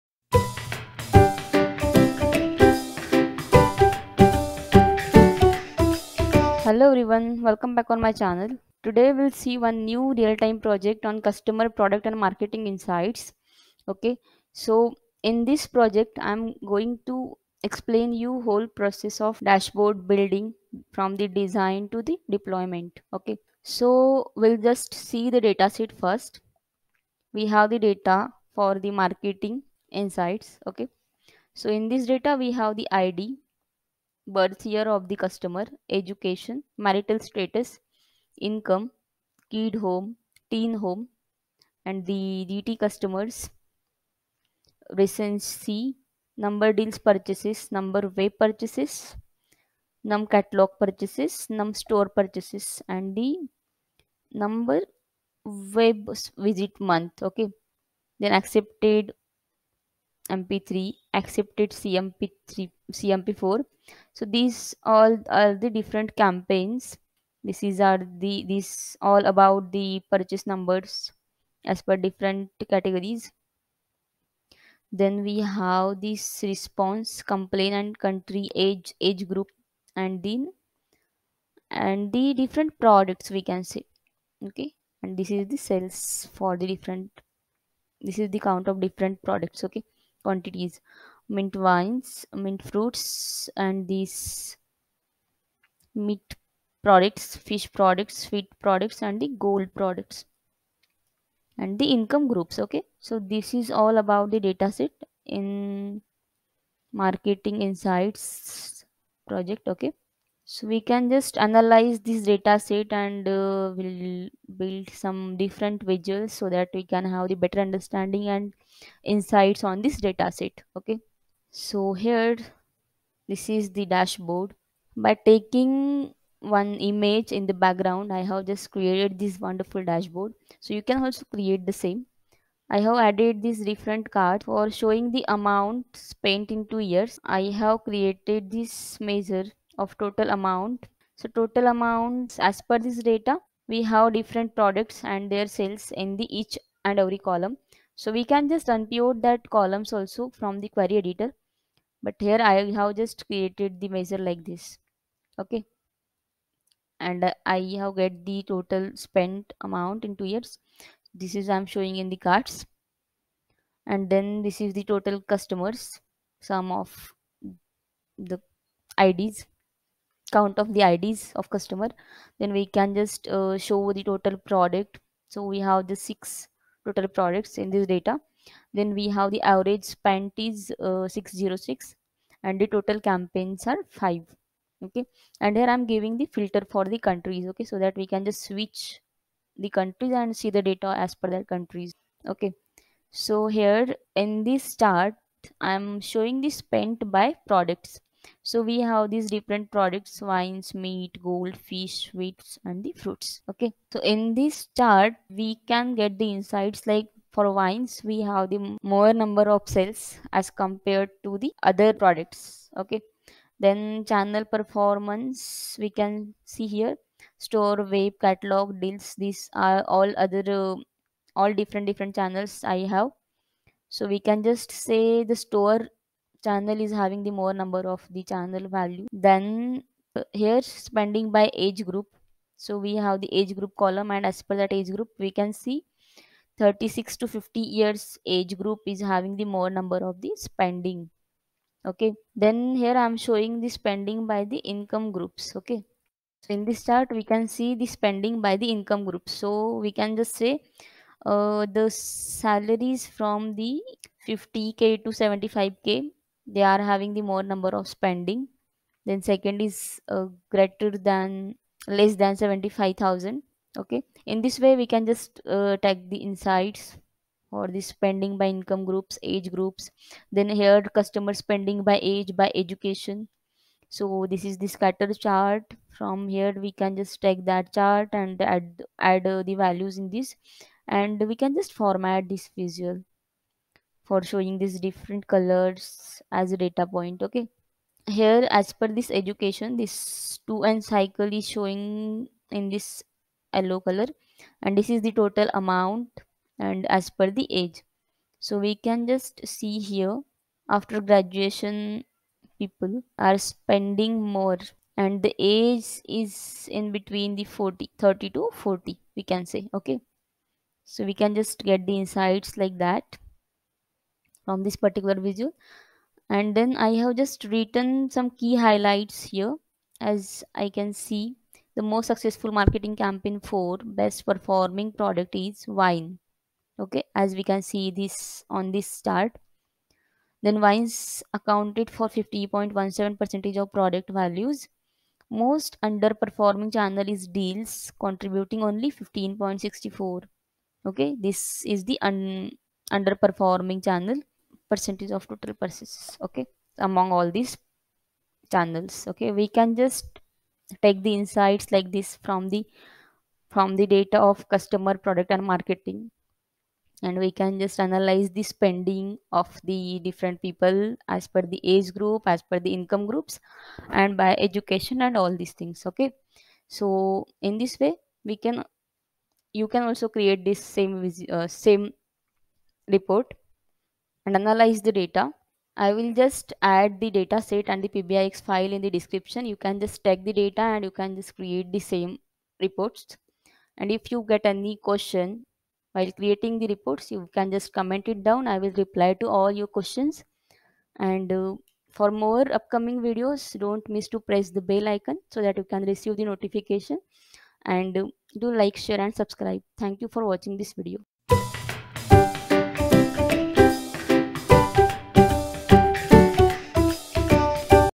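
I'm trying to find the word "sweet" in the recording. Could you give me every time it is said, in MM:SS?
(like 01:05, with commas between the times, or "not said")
01:38, 03:22.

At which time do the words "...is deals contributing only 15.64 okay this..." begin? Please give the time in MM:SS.
05:37.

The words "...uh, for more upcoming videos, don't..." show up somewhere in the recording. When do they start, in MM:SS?
06:31.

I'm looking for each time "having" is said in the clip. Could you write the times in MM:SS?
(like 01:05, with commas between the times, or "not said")
03:46, 03:59, 04:16.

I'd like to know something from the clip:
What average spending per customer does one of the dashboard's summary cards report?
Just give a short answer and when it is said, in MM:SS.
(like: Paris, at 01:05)
606, at 03:01.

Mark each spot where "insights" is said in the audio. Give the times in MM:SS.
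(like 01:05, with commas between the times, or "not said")
00:12, 00:29, 01:47, 01:59, 03:26, 04:26, 05:12, 05:51.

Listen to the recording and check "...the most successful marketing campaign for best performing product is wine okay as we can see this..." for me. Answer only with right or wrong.
right.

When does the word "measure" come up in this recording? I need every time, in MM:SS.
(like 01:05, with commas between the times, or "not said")
02:19, 02:33.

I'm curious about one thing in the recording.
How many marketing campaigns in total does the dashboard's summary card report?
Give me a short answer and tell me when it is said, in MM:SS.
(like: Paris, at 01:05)
5, at 03:03.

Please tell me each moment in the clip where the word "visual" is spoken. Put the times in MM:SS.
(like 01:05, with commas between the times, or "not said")
01:55, 04:42, 05:15.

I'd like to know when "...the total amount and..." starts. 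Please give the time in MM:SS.
04:55.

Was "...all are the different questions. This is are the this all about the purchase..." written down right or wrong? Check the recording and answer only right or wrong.
wrong.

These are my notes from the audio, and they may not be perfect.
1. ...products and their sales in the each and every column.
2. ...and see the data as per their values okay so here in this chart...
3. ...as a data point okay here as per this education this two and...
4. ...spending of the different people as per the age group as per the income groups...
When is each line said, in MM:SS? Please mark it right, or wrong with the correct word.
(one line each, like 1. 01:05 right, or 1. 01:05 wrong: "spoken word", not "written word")
1. 02:24 right
2. 03:10 wrong: "countries", not "values"
3. 04:46 right
4. 05:58 right.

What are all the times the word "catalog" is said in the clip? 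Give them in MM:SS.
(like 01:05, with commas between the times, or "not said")
00:50, 03:38.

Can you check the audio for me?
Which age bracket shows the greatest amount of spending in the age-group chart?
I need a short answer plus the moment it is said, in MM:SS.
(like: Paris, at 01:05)
36 to 50, at 03:56.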